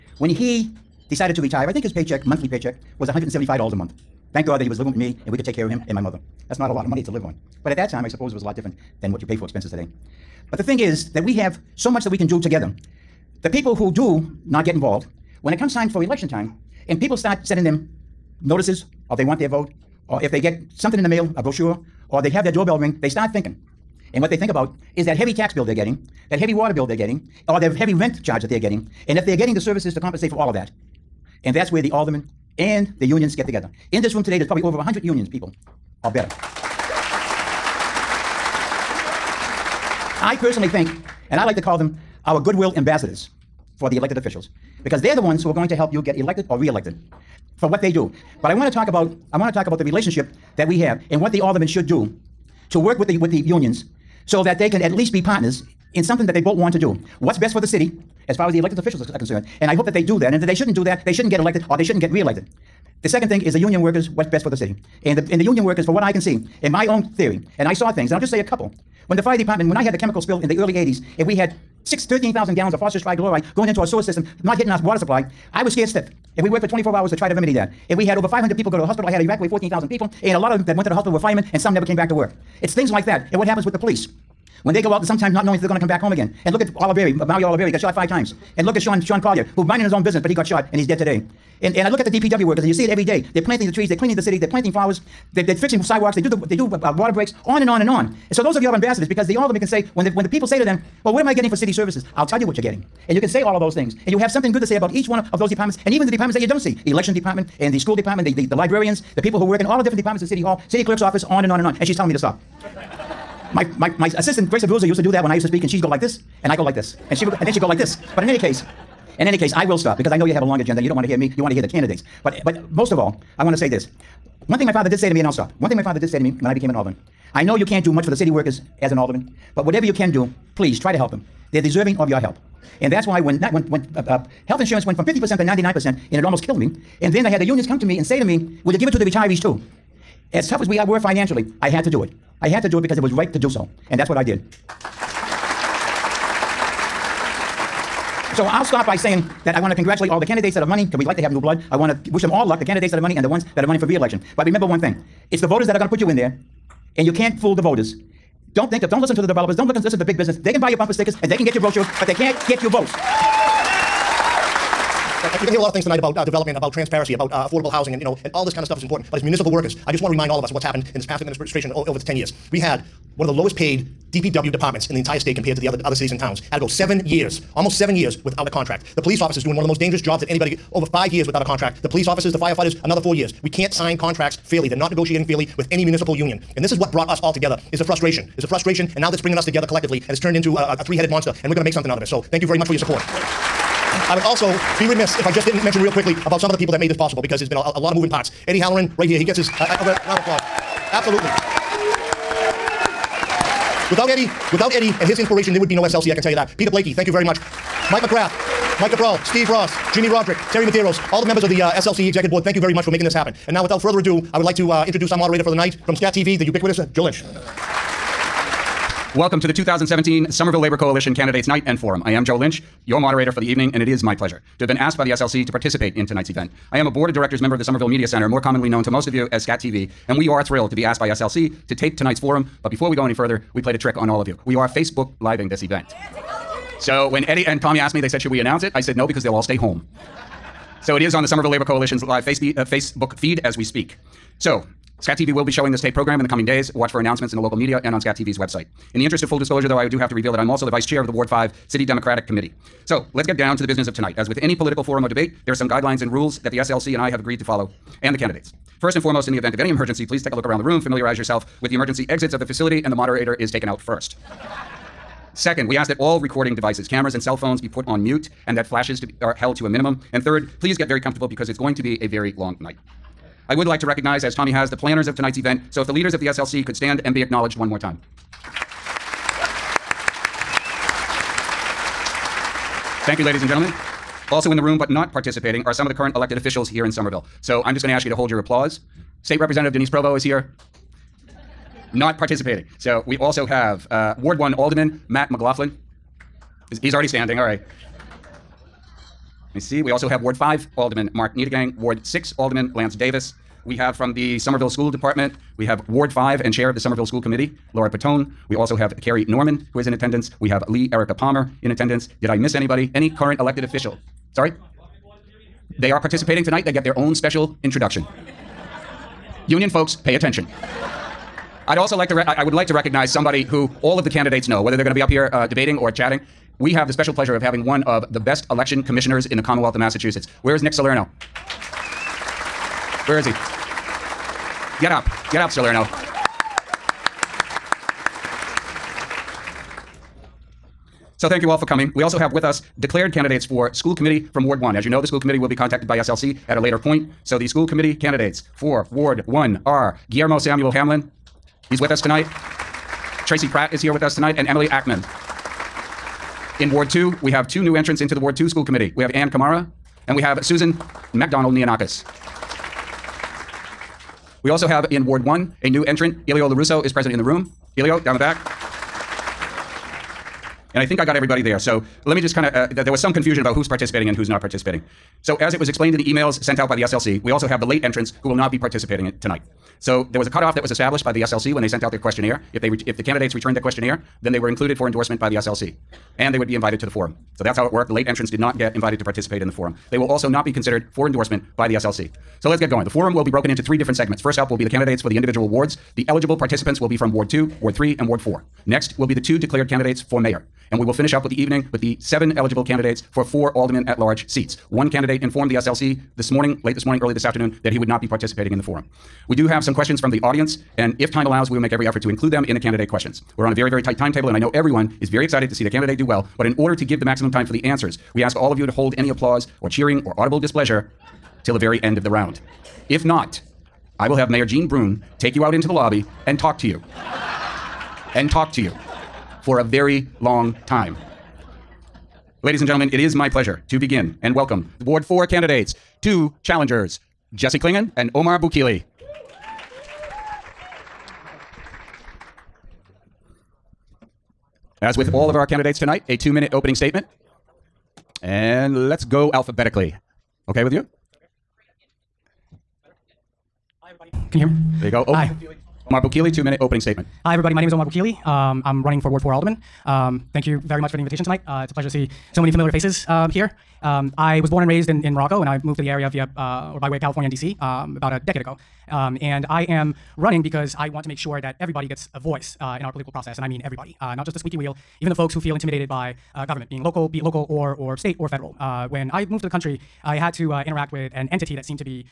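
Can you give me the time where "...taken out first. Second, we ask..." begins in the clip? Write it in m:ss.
4:23.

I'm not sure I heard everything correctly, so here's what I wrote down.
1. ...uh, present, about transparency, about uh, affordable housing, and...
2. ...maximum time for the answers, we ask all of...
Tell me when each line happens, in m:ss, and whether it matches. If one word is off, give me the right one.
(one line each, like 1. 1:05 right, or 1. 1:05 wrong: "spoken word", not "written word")
1. 2:46 wrong: "development", not "present"
2. 6:57 right.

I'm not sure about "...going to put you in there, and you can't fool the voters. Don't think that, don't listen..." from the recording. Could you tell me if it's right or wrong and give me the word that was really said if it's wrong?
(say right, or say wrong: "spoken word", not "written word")
right.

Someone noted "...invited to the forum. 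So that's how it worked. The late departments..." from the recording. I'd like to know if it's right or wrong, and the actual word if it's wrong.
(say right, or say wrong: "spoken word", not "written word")
wrong: "entrants", not "departments".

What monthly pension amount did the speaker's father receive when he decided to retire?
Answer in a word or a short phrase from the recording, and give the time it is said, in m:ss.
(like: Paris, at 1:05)
$175, at 0:03.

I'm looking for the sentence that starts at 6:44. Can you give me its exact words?
One candidate informed the SLC this morning, late this morning, early this afternoon, that he would not be participating in the forum.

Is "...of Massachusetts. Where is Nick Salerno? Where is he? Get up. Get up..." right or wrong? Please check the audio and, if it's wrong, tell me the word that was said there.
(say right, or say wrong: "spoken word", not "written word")
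right.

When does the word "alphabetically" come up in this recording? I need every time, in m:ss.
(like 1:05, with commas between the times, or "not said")
7:29.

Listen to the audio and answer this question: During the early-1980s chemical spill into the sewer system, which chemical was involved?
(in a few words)
phosphorus trichloride.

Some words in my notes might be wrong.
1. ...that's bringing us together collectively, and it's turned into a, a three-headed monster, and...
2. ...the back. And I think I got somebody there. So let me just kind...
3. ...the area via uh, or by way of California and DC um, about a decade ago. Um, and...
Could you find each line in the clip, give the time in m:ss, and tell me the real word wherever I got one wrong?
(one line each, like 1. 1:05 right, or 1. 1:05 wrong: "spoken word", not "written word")
1. 3:09 right
2. 6:08 wrong: "everybody", not "somebody"
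3. 7:45 right.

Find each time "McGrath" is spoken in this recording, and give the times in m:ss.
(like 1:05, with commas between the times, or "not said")
3:28.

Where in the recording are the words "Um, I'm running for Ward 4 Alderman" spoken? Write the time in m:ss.
7:38.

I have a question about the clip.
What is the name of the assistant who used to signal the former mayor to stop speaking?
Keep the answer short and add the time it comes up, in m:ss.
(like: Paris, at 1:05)
Grace Abruzzo, at 1:54.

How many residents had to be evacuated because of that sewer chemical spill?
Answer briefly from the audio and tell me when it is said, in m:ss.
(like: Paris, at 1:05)
14,000, at 1:19.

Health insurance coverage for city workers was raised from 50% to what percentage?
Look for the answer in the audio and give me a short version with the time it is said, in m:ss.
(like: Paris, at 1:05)
99%, at 2:15.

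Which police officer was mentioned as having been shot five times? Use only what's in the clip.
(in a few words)
Mario Oliveri.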